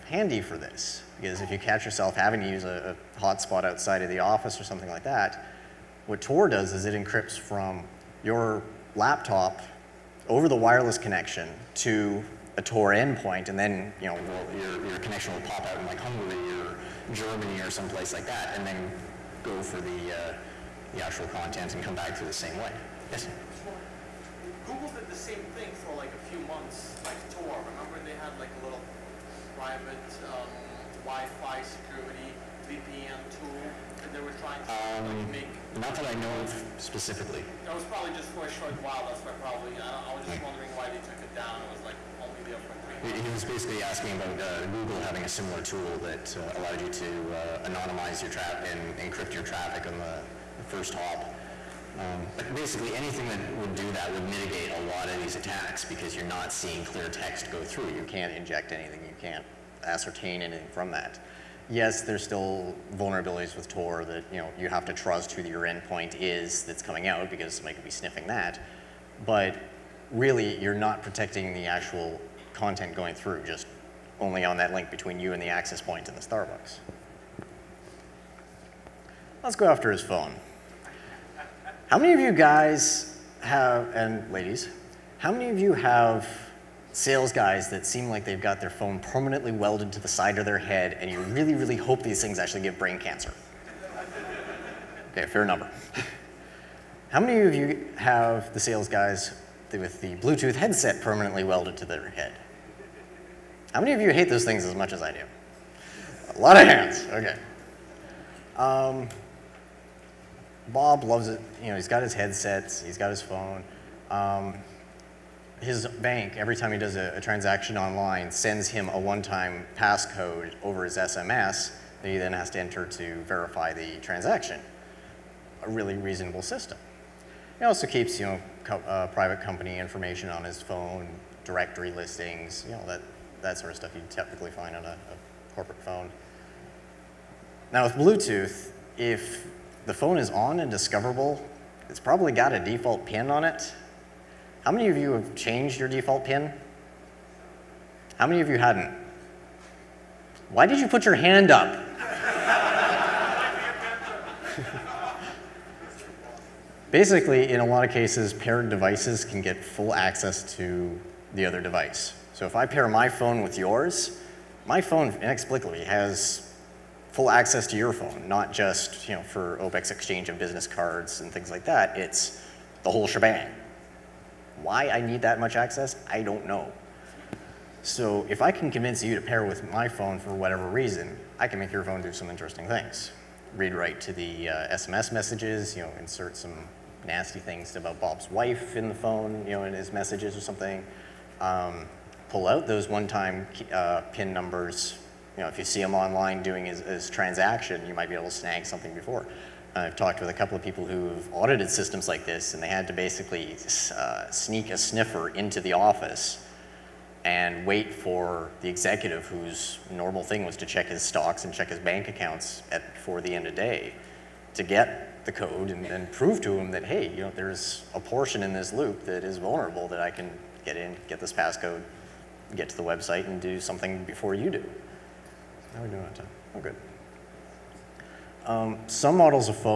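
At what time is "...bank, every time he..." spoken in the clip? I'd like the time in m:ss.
1:55.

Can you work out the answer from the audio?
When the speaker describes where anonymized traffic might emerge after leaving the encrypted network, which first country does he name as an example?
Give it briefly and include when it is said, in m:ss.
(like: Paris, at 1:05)
Hungary, at 0:15.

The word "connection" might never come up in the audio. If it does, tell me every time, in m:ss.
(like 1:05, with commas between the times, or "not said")
0:10, 0:14.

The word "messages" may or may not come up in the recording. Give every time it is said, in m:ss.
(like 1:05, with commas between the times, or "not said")
3:05, 3:09.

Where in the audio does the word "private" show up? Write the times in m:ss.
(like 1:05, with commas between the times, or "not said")
0:29, 2:09.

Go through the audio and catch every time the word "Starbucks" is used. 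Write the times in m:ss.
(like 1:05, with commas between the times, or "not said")
1:16.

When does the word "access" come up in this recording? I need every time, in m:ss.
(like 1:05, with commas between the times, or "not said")
1:15, 2:39, 2:47, 2:55.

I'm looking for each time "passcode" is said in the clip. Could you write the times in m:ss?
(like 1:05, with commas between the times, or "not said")
1:59, 3:41.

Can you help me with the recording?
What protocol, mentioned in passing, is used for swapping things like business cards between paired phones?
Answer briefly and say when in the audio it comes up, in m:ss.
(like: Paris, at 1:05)
OBEX, at 2:49.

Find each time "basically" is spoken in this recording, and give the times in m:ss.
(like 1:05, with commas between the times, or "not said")
0:43, 0:52, 2:36, 3:22.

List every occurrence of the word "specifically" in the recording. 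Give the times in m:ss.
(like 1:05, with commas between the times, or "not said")
0:36.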